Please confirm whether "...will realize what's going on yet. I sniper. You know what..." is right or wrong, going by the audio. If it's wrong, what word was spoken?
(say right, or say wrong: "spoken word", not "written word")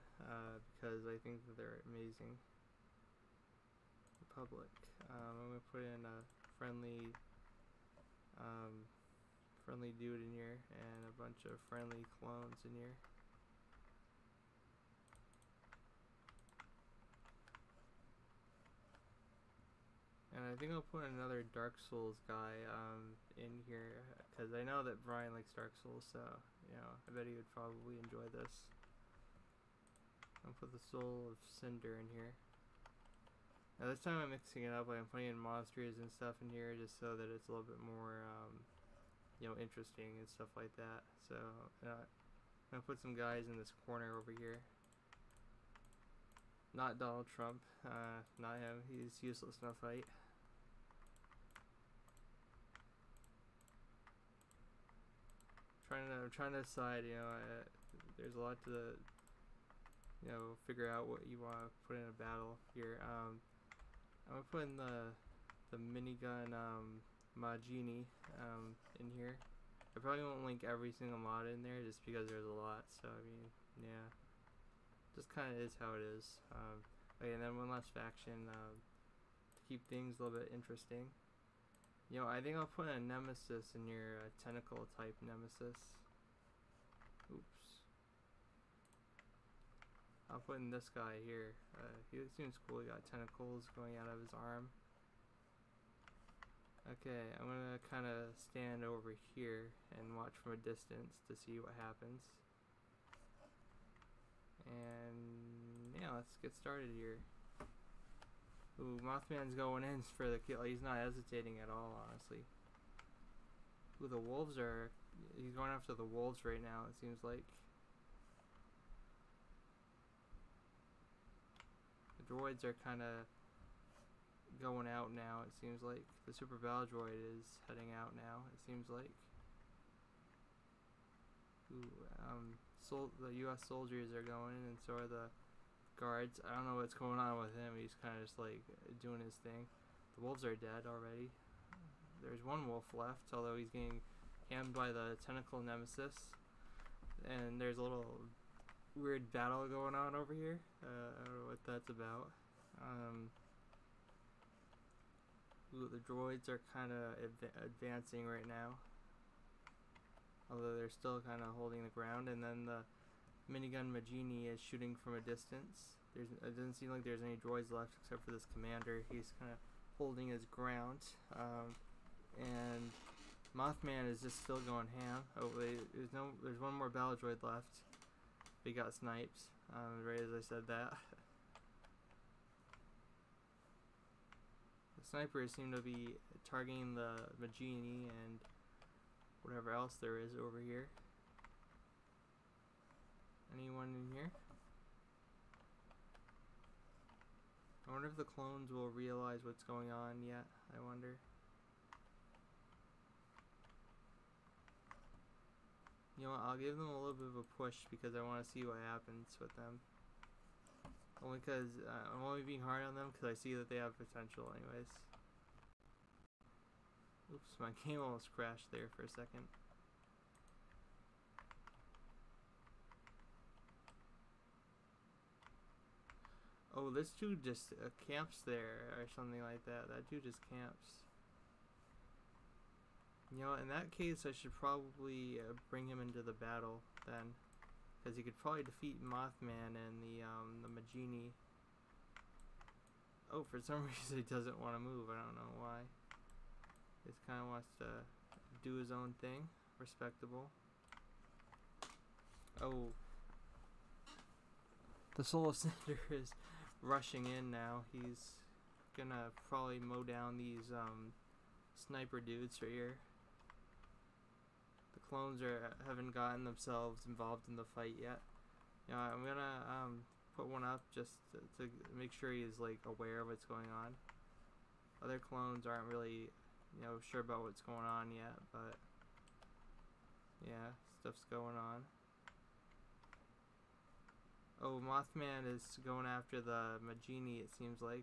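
wrong: "wonder", not "sniper".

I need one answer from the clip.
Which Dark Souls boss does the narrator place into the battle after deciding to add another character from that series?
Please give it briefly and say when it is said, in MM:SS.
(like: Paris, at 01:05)
Soul of Cinder, at 00:30.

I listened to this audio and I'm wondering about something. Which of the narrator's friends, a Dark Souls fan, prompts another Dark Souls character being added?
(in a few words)
Brian.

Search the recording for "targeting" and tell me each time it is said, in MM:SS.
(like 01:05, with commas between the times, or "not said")
03:06.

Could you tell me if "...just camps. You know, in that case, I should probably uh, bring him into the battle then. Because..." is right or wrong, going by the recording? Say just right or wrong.
right.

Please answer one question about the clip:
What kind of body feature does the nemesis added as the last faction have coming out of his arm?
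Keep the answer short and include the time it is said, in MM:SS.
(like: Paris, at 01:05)
Tentacles, at 01:33.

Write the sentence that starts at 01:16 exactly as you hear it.
Um, okay, and then one last faction um, to keep things a little bit interesting.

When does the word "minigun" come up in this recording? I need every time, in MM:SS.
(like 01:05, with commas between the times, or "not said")
01:05, 02:43.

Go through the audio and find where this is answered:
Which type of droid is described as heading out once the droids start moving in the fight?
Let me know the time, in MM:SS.
02:06.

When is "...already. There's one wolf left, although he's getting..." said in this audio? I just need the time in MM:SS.
02:20.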